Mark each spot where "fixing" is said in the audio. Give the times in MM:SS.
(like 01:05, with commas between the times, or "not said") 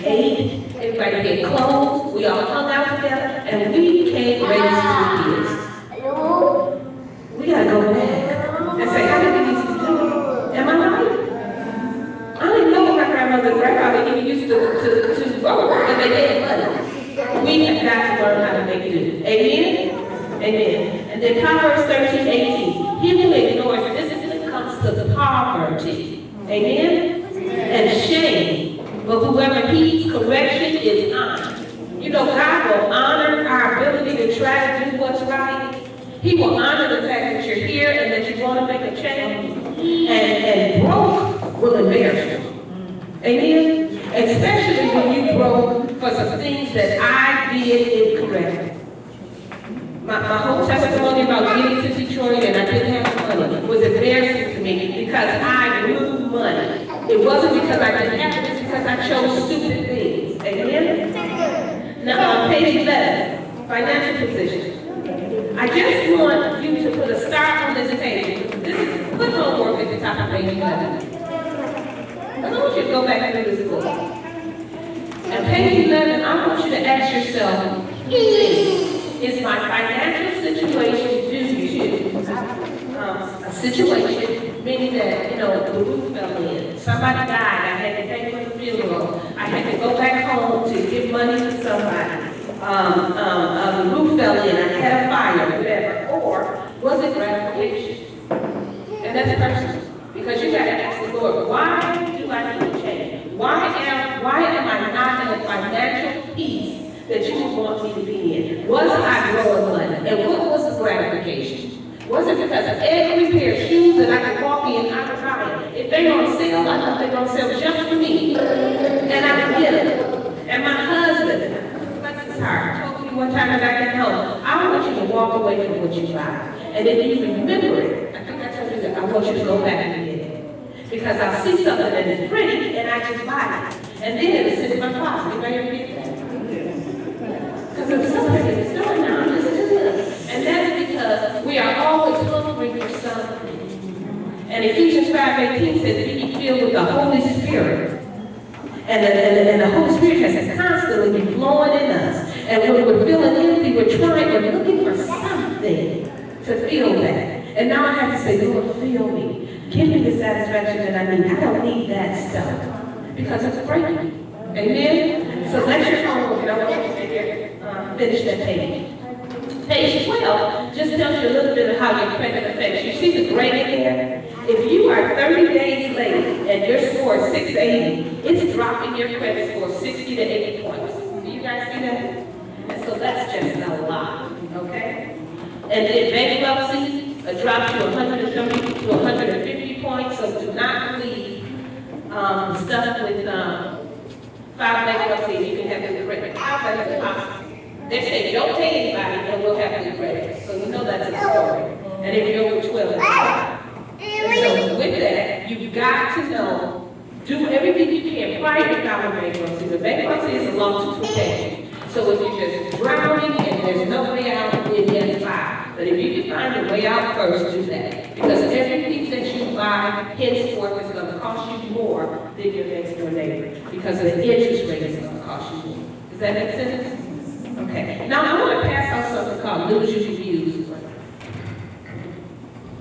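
not said.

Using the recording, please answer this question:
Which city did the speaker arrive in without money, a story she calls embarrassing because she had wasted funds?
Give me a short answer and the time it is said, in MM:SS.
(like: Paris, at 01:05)
Detroit, at 00:51.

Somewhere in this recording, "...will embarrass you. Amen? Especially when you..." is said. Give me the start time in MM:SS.
00:41.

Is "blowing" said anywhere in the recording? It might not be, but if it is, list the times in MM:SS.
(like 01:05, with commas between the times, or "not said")
01:49.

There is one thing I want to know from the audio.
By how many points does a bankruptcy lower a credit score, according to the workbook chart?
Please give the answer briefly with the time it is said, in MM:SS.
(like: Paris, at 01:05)
130 to 150, at 03:07.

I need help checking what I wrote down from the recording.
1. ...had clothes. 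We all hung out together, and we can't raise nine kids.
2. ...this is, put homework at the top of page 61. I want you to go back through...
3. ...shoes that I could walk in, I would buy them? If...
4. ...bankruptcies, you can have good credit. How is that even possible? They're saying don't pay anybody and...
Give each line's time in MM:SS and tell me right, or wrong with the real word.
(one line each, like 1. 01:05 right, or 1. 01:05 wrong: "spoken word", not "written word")
1. 00:01 wrong: "three", not "nine"
2. 01:08 wrong: "11", not "61"
3. 01:53 right
4. 03:14 right.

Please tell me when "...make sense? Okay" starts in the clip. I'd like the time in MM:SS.
03:46.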